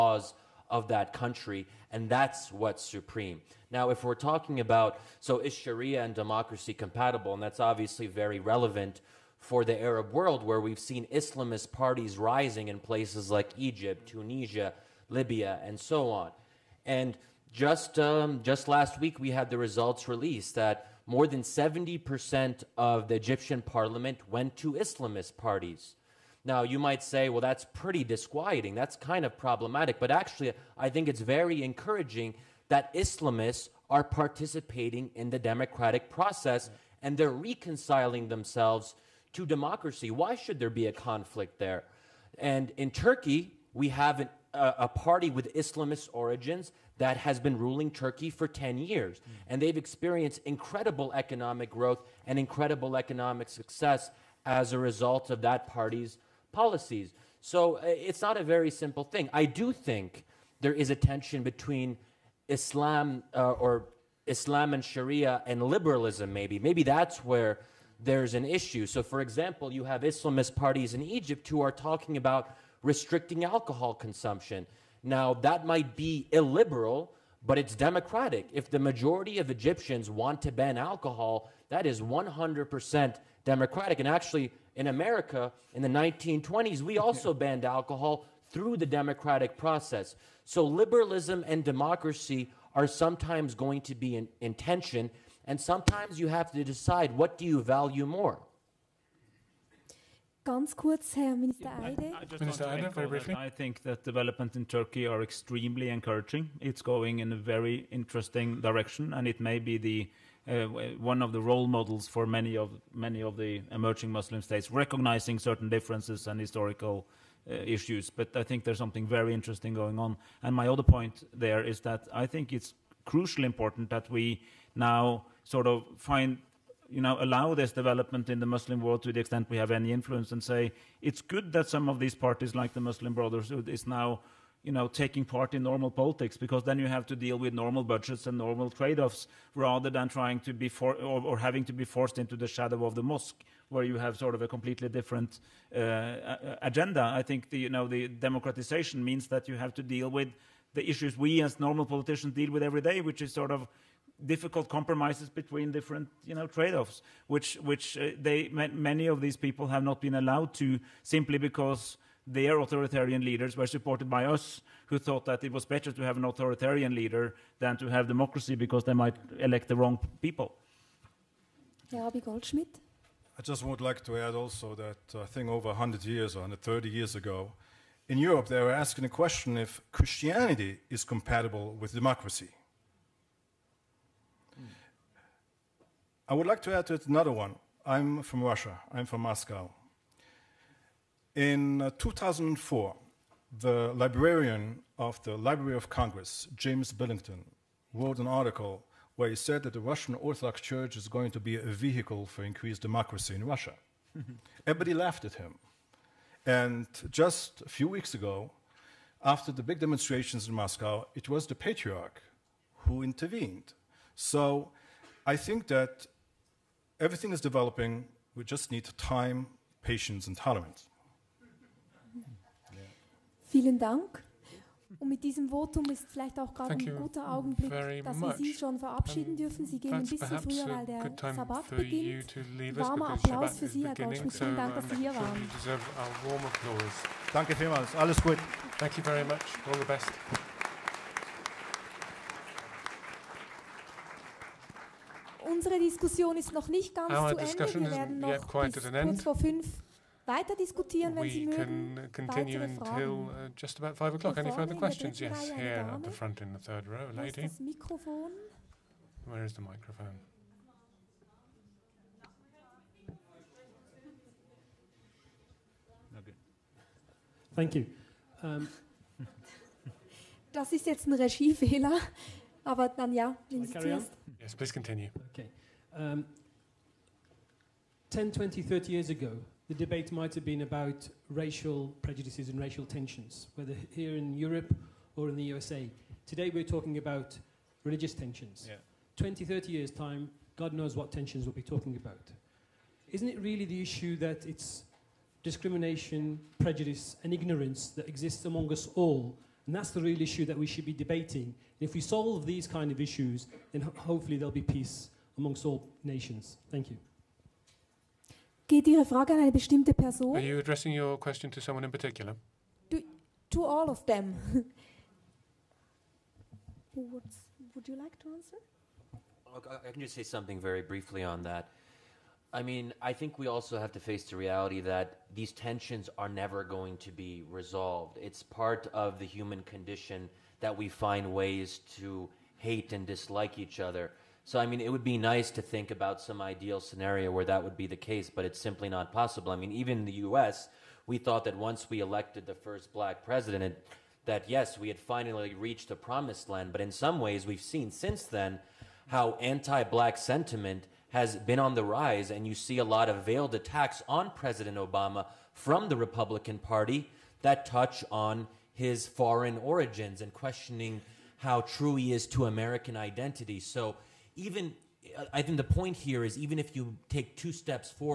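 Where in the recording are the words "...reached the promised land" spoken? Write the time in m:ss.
5:45.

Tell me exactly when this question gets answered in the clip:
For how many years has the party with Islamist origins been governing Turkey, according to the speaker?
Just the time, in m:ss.
0:48.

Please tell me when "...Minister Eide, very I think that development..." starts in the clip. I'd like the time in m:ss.
1:42.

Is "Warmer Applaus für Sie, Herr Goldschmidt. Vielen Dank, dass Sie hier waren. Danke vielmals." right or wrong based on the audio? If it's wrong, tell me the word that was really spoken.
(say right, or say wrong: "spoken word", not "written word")
right.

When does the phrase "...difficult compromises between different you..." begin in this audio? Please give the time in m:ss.
2:34.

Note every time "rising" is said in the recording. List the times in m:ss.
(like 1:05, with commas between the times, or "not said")
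0:12.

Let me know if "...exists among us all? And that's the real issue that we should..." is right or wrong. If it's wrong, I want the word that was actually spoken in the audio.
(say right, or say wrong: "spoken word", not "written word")
right.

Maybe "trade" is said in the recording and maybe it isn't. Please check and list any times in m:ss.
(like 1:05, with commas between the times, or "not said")
2:18, 2:36.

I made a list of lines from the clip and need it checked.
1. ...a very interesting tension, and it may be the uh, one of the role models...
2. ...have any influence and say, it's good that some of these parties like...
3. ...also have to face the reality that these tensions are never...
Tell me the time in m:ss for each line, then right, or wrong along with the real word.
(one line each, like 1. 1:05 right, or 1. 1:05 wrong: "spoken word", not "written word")
1. 1:47 wrong: "direction", not "tension"
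2. 2:09 right
3. 5:23 right.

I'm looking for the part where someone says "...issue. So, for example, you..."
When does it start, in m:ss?
1:08.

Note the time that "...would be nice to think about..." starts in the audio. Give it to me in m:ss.
5:34.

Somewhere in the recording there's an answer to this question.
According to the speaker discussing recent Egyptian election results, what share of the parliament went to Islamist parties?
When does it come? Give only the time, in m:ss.
0:21.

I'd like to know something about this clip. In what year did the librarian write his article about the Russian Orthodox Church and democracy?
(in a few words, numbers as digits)
2004.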